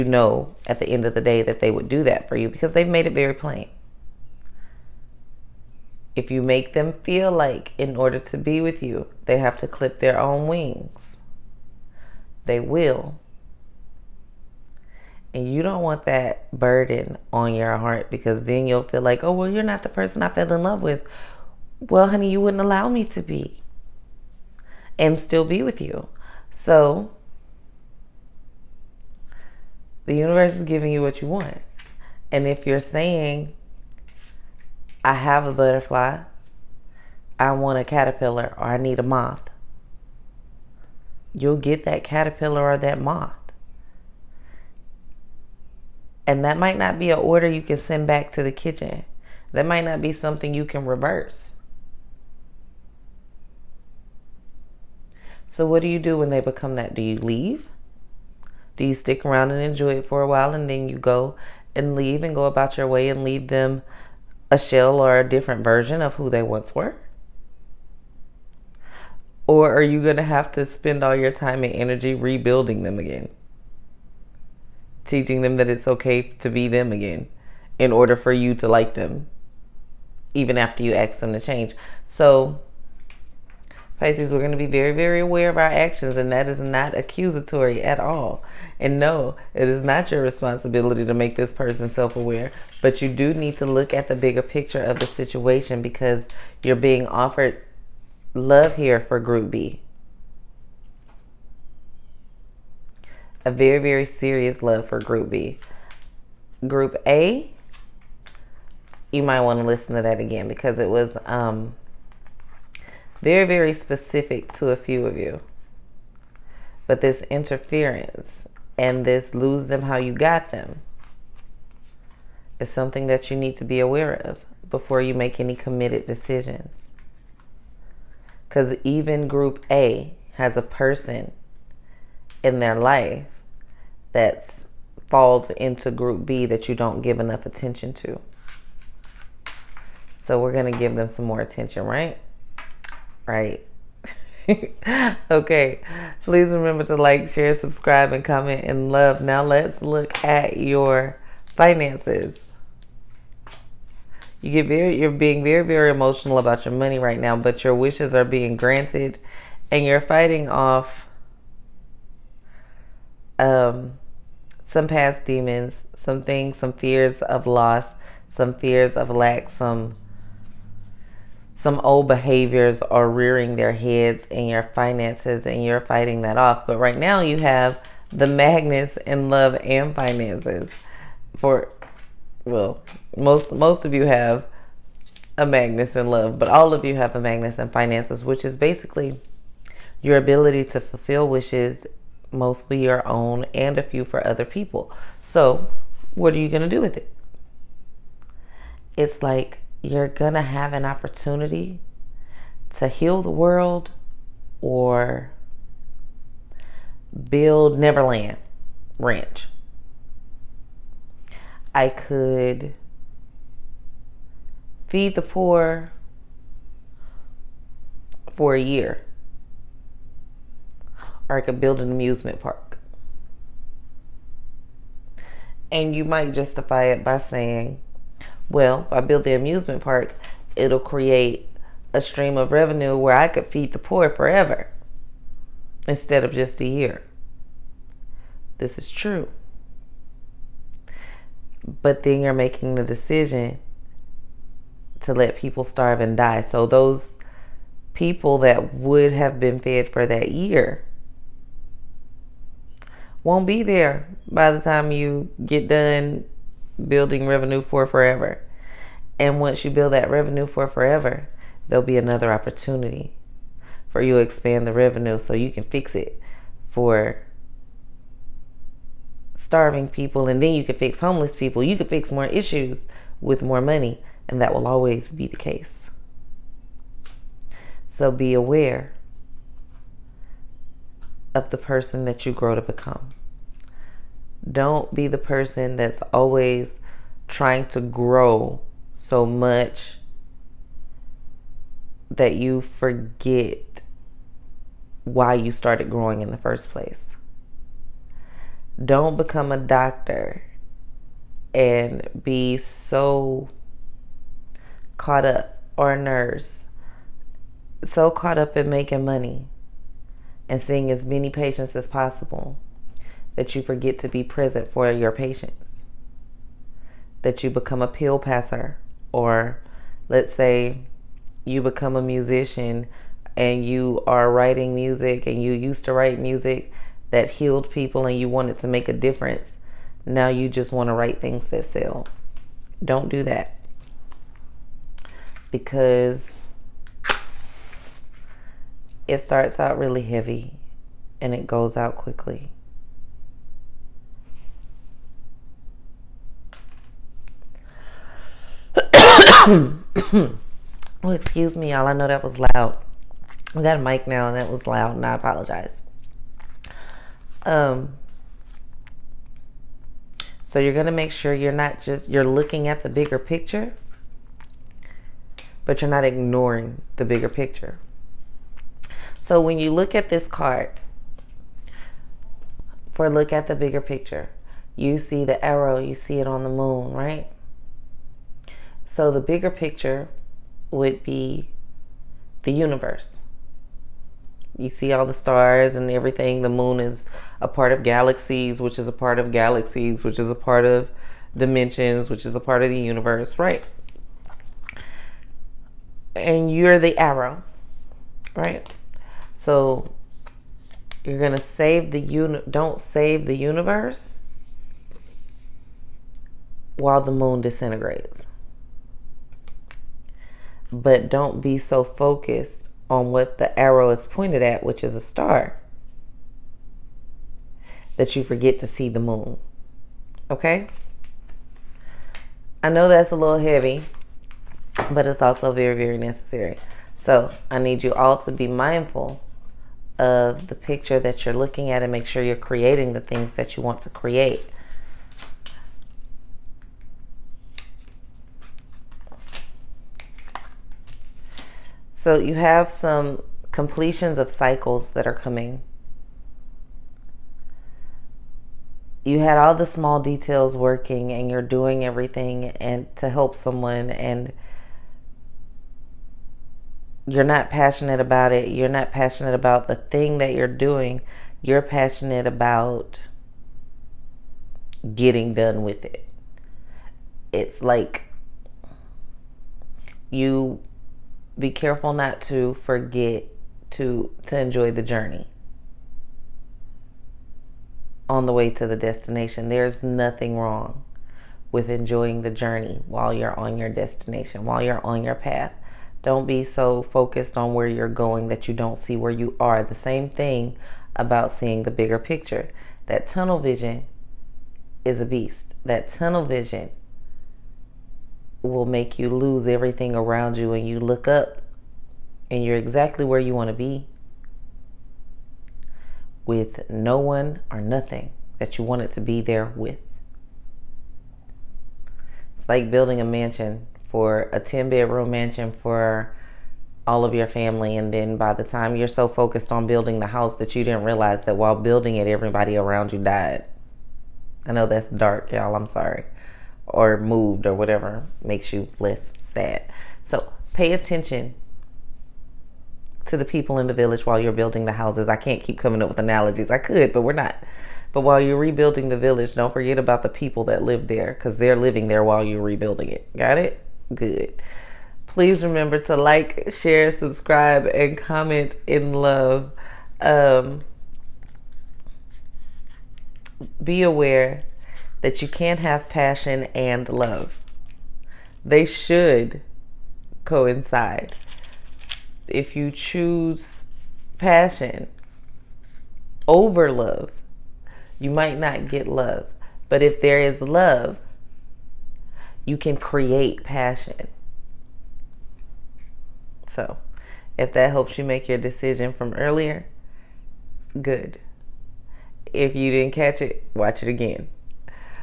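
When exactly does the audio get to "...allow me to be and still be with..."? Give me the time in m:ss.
0:22.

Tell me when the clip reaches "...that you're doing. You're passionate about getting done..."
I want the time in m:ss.
7:40.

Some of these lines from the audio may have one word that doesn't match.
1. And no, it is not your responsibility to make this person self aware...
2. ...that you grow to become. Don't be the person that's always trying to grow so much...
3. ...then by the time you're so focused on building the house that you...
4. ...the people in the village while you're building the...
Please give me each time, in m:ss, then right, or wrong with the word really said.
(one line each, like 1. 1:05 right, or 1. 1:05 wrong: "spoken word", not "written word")
1. 1:28 right
2. 4:42 right
3. 8:37 right
4. 8:53 right.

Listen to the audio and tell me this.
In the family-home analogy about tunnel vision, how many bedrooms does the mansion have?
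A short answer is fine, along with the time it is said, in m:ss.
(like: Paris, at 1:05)
10, at 8:34.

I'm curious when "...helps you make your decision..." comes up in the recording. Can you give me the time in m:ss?
9:37.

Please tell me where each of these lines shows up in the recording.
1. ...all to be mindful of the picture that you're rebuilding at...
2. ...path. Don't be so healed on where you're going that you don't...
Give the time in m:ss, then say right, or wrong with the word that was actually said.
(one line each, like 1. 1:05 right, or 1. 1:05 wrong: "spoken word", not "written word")
1. 7:07 wrong: "looking", not "rebuilding"
2. 8:05 wrong: "focused", not "healed".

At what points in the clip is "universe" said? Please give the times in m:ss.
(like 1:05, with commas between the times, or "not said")
0:30, 6:22, 6:32, 6:43.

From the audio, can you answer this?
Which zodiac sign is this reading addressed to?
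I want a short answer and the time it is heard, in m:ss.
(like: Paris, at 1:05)
Pisces, at 1:23.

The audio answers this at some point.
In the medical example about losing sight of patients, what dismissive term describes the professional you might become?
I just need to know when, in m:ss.
5:17.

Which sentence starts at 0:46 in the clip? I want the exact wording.
And that might not be an order you can send back to the kitchen.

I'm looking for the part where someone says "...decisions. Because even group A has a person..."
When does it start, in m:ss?
2:06.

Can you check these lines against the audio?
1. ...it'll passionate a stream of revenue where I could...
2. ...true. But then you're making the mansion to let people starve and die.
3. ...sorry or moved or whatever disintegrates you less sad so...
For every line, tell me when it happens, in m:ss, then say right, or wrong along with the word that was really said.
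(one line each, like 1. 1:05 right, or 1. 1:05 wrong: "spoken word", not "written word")
1. 3:50 wrong: "create", not "passionate"
2. 3:58 wrong: "decision", not "mansion"
3. 8:45 wrong: "makes", not "disintegrates".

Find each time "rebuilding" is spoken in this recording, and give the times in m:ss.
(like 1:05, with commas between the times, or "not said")
1:12, 8:58, 9:02.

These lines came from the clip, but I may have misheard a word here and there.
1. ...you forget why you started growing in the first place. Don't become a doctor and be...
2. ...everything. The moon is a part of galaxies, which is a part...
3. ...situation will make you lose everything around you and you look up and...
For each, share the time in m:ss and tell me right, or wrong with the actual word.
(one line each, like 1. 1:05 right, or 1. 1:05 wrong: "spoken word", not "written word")
1. 4:52 right
2. 6:25 right
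3. 8:16 wrong: "vision", not "situation".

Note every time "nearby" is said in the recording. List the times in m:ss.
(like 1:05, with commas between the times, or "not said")
not said.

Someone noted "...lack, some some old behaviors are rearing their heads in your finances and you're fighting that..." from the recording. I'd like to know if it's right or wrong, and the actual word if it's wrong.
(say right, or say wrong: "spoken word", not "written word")
right.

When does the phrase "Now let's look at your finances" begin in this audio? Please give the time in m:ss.
2:29.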